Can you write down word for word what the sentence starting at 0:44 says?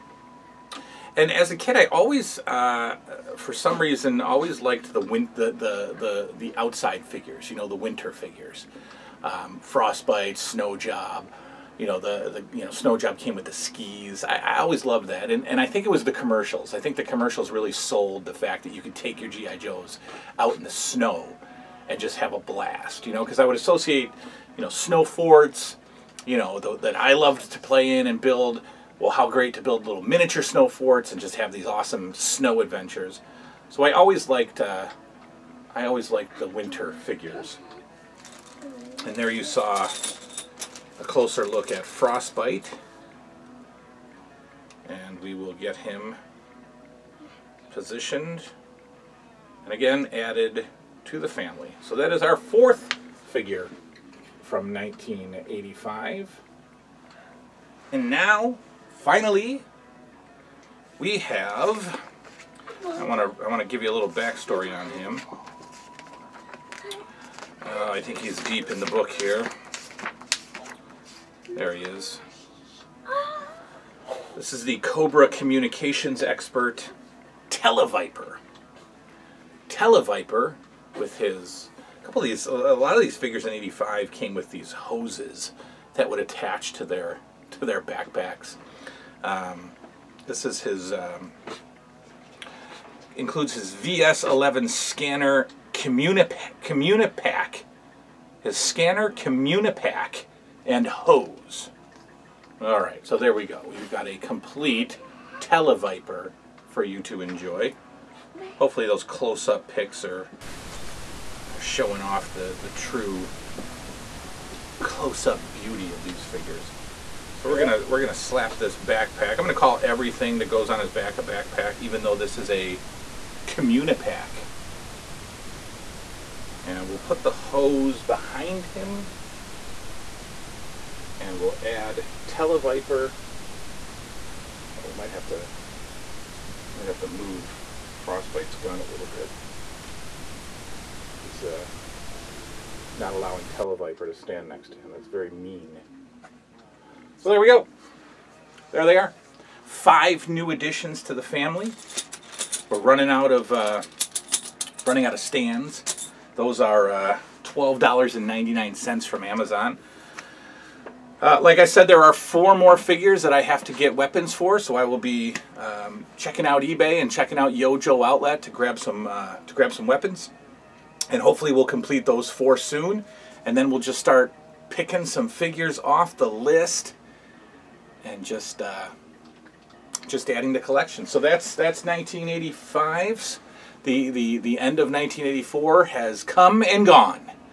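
And we will get him positioned and again added to the family.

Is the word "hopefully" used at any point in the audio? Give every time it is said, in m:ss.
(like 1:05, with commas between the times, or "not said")
1:48, 2:51.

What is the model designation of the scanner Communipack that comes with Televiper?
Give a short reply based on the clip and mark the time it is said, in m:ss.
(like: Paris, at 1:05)
VS11, at 1:33.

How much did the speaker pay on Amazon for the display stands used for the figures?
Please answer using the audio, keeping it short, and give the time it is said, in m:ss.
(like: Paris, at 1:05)
$12.99, at 2:37.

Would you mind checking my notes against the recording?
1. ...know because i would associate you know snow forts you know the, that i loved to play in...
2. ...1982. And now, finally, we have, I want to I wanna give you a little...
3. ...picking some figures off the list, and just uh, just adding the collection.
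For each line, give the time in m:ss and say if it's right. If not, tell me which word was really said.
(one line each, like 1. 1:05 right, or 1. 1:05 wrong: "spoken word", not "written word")
1. 0:23 right
2. 0:54 wrong: "1985", not "1982"
3. 2:54 right.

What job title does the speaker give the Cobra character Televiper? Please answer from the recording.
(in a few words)
communications expert.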